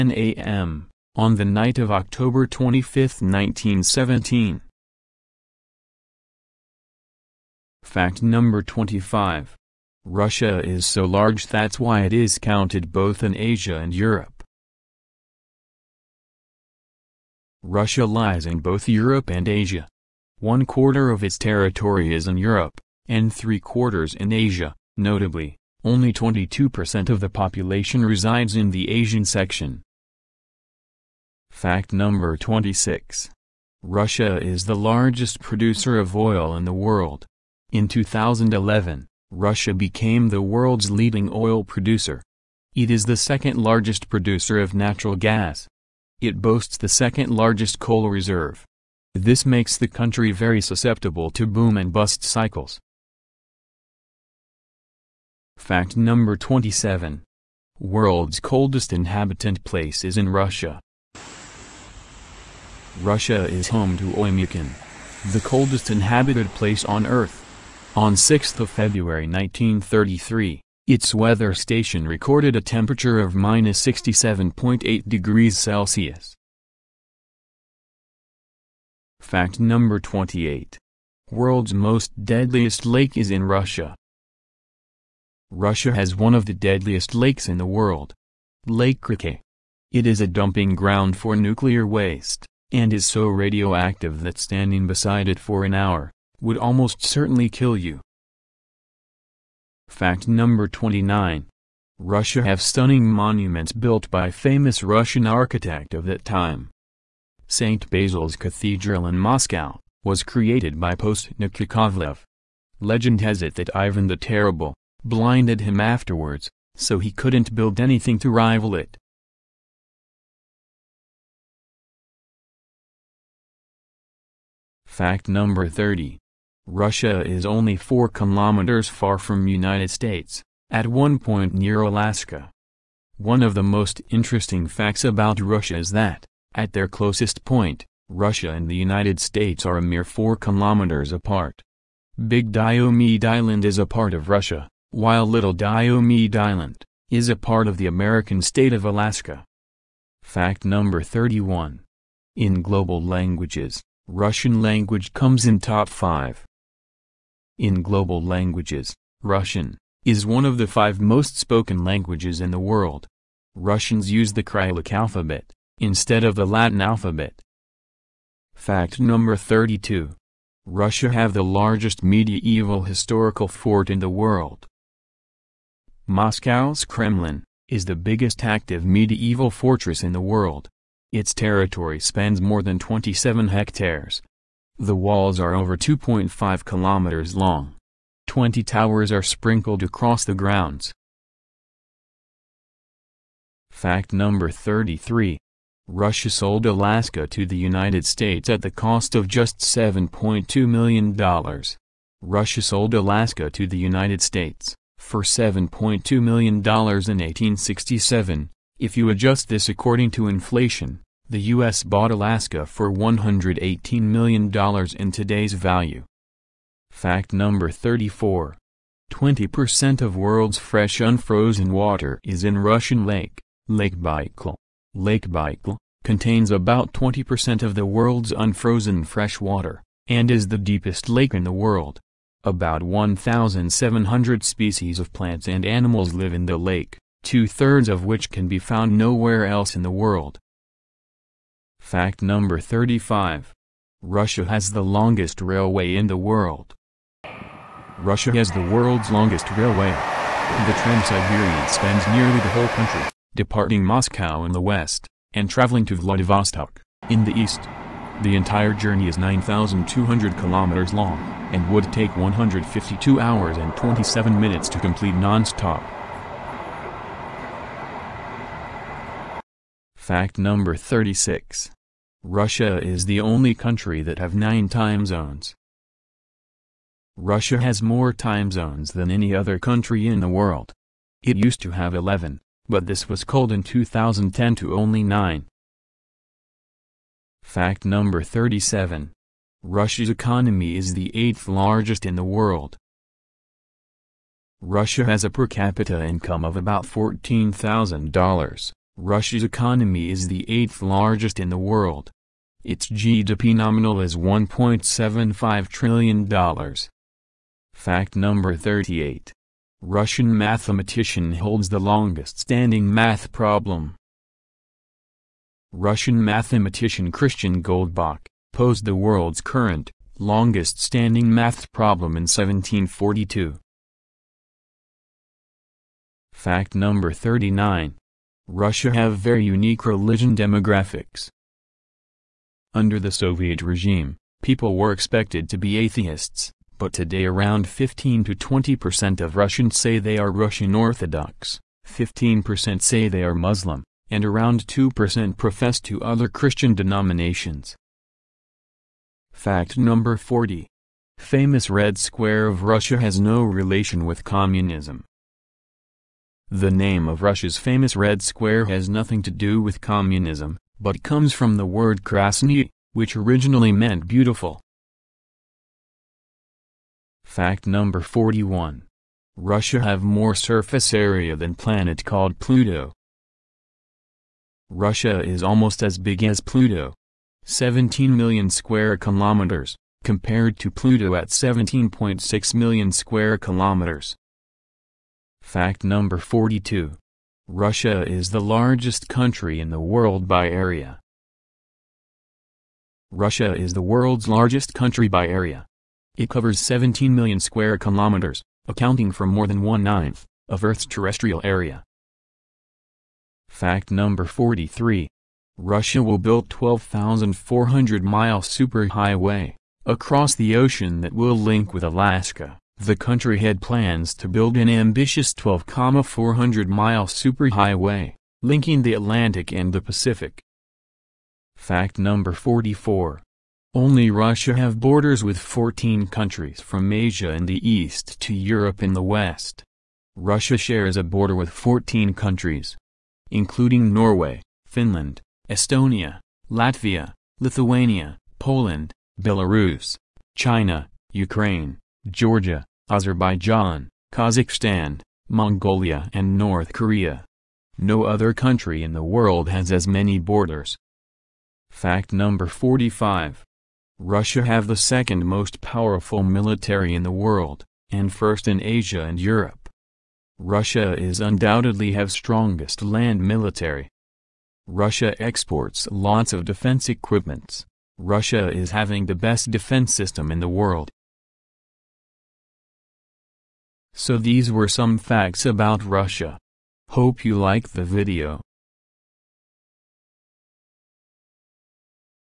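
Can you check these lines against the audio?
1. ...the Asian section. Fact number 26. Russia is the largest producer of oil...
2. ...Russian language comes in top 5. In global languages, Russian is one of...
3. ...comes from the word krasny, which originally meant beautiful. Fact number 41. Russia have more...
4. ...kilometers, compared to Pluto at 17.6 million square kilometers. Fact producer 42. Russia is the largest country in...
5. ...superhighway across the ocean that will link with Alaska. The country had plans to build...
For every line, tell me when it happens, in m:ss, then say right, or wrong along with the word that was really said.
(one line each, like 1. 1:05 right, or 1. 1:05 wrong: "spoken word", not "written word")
1. 0:28 right
2. 2:34 right
3. 6:01 right
4. 6:18 wrong: "number", not "producer"
5. 6:48 right.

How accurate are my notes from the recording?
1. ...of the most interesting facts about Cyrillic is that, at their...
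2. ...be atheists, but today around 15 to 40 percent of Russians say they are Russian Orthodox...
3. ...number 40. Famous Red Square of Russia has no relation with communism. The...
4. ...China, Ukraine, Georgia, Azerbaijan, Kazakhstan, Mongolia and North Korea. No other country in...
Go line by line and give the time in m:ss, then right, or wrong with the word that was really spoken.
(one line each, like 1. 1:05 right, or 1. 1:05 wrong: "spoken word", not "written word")
1. 2:13 wrong: "Russia", not "Cyrillic"
2. 5:35 wrong: "20", not "40"
3. 5:49 right
4. 7:20 right.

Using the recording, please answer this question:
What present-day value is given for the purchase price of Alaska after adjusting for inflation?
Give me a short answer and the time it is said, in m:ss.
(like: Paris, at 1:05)
$118 million, at 3:32.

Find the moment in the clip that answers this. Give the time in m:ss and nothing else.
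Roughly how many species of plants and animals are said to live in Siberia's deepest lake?
3:52.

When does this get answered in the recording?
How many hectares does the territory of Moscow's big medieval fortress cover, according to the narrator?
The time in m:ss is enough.
3:02.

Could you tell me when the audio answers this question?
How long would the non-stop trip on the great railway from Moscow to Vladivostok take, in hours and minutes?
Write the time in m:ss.
4:22.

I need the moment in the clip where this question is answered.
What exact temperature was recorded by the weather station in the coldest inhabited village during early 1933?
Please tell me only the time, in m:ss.
1:13.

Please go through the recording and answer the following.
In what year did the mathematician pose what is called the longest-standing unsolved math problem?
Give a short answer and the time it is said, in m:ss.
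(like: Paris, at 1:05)
1742, at 5:22.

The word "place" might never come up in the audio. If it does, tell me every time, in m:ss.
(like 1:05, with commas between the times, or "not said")
0:59, 1:06.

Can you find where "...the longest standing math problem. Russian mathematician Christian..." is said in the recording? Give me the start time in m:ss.
5:11.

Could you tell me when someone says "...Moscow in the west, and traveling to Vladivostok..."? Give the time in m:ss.
4:13.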